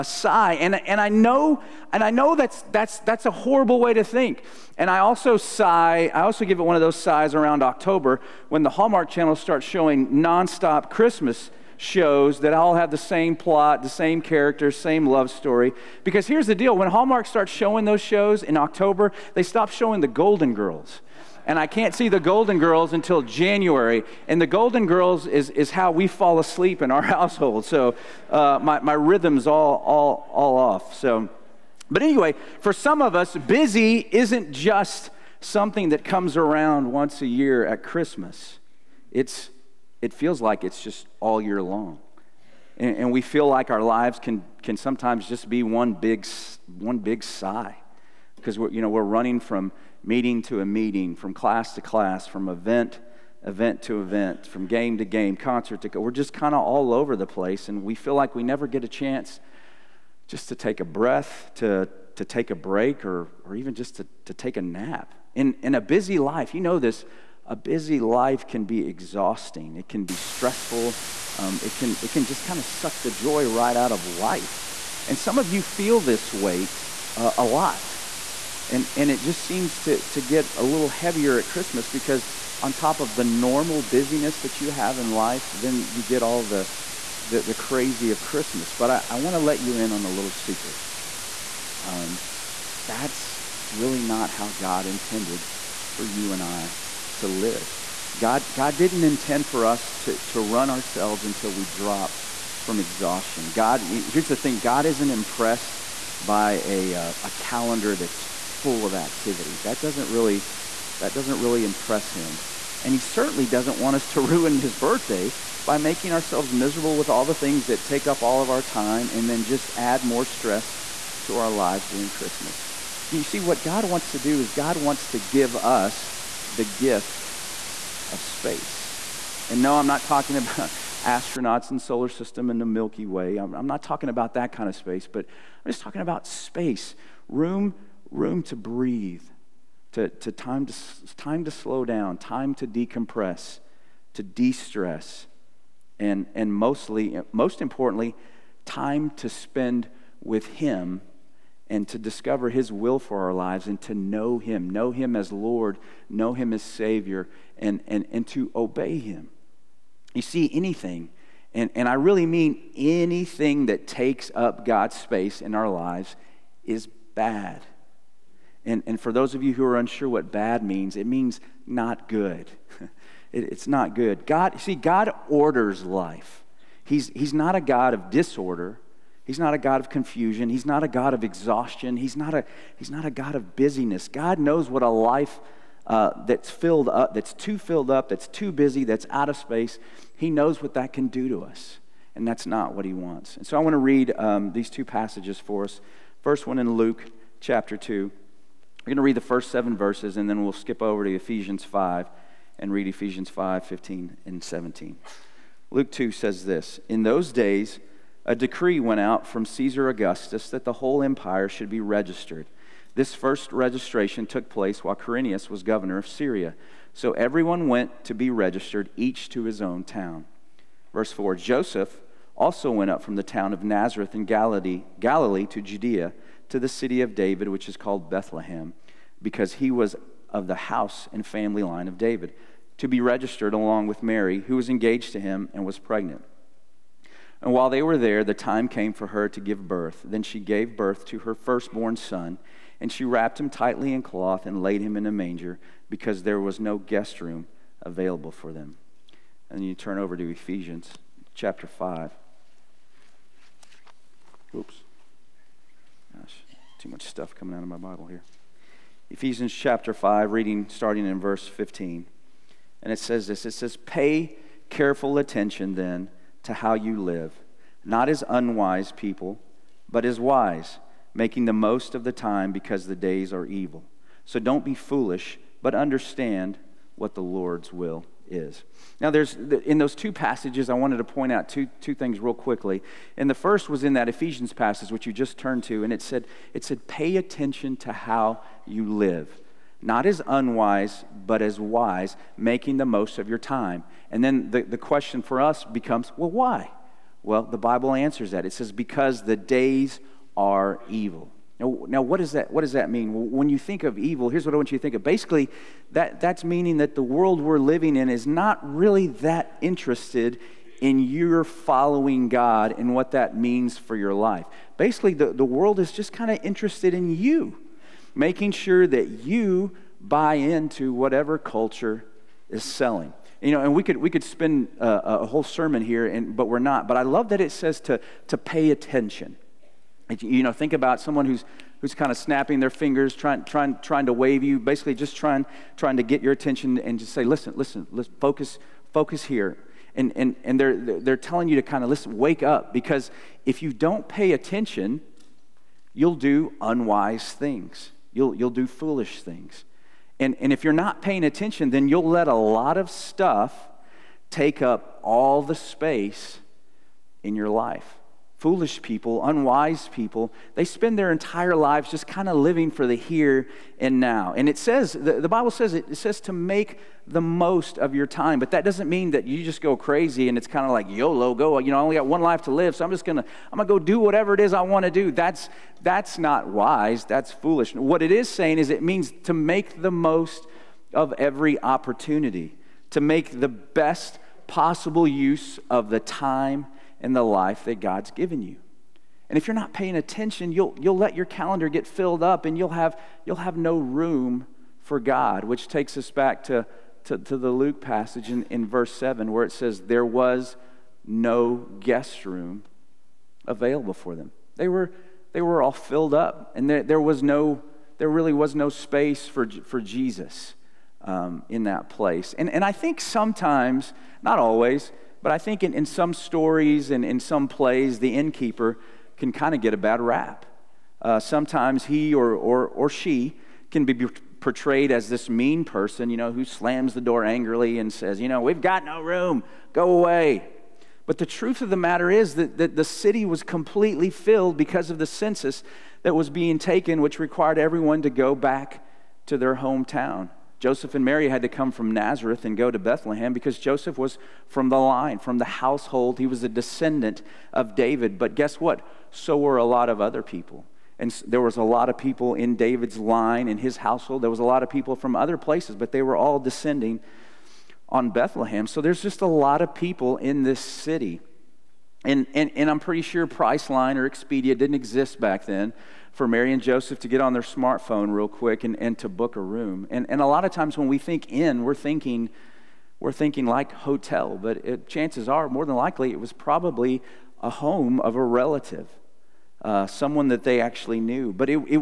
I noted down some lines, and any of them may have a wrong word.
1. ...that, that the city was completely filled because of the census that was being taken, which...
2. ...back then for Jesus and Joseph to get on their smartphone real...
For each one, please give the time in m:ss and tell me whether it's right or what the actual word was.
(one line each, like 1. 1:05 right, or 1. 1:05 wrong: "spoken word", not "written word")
1. 7:12 right
2. 7:45 wrong: "Mary", not "Jesus".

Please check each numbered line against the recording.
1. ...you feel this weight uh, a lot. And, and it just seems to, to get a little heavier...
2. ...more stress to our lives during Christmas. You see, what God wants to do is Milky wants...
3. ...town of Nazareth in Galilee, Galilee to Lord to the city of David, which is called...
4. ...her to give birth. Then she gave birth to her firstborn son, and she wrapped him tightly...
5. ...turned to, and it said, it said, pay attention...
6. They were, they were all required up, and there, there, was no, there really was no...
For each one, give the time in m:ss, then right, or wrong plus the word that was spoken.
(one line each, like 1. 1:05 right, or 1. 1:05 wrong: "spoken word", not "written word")
1. 1:15 right
2. 2:00 wrong: "God", not "Milky"
3. 3:43 wrong: "Judea", not "Lord"
4. 3:59 right
5. 4:45 right
6. 6:44 wrong: "filled", not "required".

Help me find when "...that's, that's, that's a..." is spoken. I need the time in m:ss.
0:02.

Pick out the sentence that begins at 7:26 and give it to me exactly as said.
He was a descendant of David.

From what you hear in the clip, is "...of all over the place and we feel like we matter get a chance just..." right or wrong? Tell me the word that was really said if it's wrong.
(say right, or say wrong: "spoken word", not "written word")
wrong: "never", not "matter".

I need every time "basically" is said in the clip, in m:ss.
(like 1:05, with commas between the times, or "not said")
5:05, 5:14, 5:34.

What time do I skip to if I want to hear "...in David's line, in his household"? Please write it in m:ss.
7:32.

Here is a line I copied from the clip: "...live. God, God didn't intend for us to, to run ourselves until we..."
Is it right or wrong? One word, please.
right.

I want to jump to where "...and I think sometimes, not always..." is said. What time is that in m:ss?
6:52.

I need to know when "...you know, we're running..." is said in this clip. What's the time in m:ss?
0:48.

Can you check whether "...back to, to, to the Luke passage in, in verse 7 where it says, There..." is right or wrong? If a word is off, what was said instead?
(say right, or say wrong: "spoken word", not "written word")
right.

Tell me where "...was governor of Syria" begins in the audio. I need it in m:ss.
3:35.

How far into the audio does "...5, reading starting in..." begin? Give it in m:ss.
4:19.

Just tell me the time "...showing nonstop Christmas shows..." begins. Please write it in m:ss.
0:09.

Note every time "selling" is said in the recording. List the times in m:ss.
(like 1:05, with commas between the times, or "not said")
5:22.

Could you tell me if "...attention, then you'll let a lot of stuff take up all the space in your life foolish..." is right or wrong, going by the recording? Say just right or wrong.
right.